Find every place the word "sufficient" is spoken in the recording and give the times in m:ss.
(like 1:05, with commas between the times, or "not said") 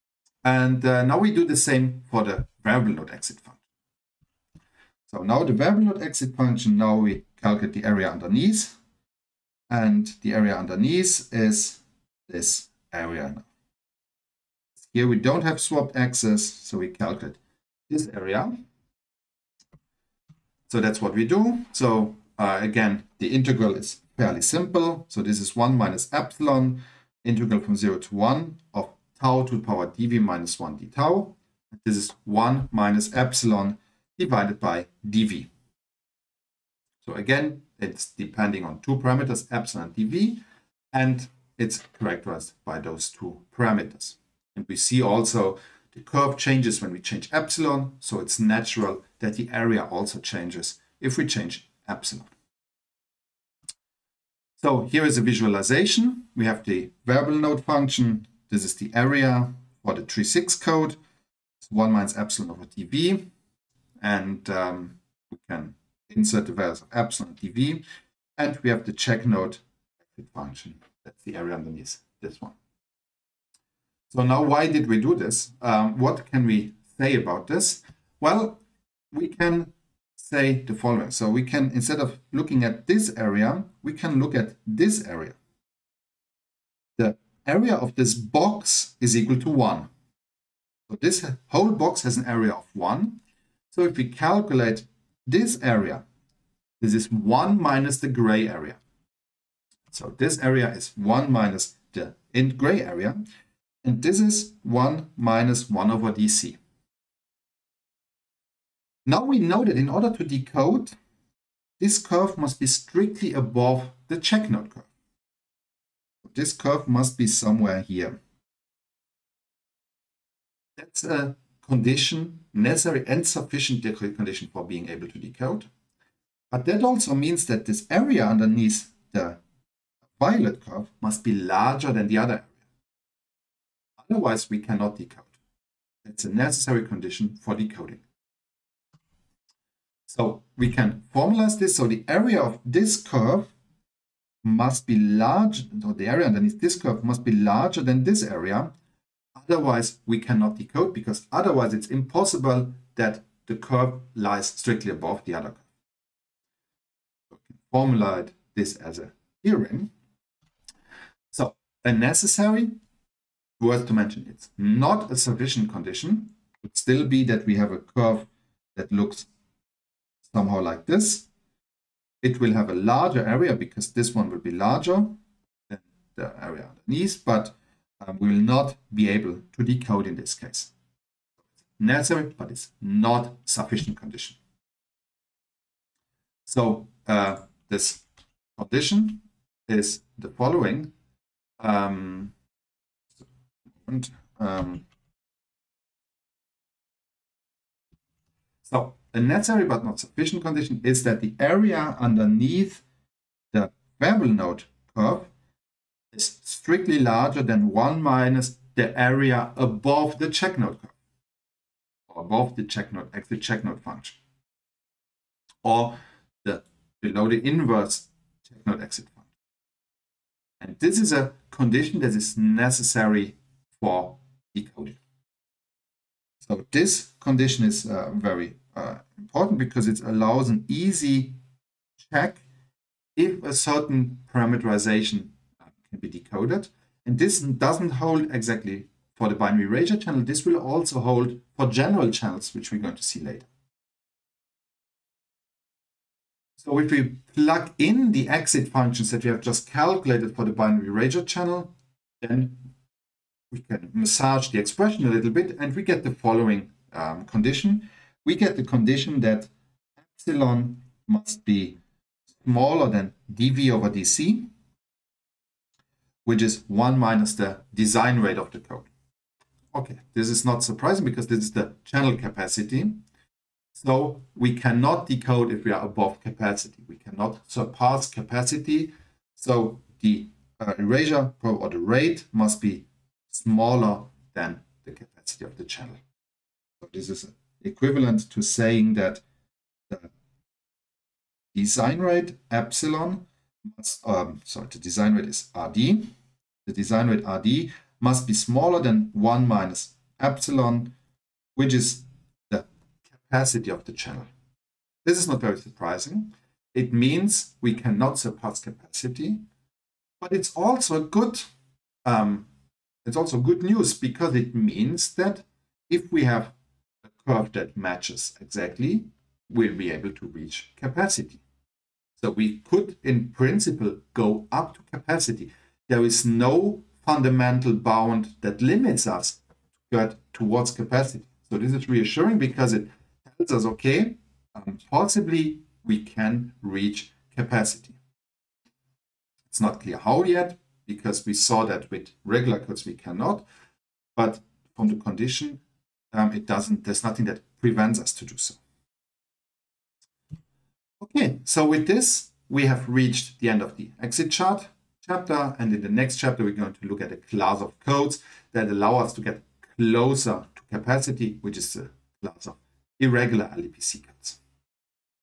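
2:03, 2:45, 3:03, 3:19.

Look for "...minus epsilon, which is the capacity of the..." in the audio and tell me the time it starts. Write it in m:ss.
4:59.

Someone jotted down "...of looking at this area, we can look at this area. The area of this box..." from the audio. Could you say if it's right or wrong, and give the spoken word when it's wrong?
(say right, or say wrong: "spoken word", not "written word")
right.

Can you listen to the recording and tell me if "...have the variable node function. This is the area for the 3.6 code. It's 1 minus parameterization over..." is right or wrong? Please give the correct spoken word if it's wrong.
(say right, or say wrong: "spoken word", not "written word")
wrong: "epsilon", not "parameterization".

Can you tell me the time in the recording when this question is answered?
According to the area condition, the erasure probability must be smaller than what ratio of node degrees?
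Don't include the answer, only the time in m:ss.
4:23.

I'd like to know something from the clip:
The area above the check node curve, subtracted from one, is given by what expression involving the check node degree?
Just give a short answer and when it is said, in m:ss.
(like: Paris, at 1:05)
1 minus 1 over dc, at 1:44.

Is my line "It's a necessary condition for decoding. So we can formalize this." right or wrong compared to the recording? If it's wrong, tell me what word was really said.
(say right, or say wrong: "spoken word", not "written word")
right.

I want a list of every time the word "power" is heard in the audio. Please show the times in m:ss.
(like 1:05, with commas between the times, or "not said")
0:29.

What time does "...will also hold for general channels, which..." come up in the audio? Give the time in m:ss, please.
4:00.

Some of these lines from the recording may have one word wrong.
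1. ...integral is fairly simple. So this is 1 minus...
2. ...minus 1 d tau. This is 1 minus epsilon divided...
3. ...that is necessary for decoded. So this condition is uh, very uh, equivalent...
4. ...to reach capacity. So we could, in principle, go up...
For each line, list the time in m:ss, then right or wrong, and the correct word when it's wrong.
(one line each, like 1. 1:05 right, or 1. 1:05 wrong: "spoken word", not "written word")
1. 0:23 right
2. 0:30 right
3. 3:41 wrong: "important", not "equivalent"
4. 5:20 right.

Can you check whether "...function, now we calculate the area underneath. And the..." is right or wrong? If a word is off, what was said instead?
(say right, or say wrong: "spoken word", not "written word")
right.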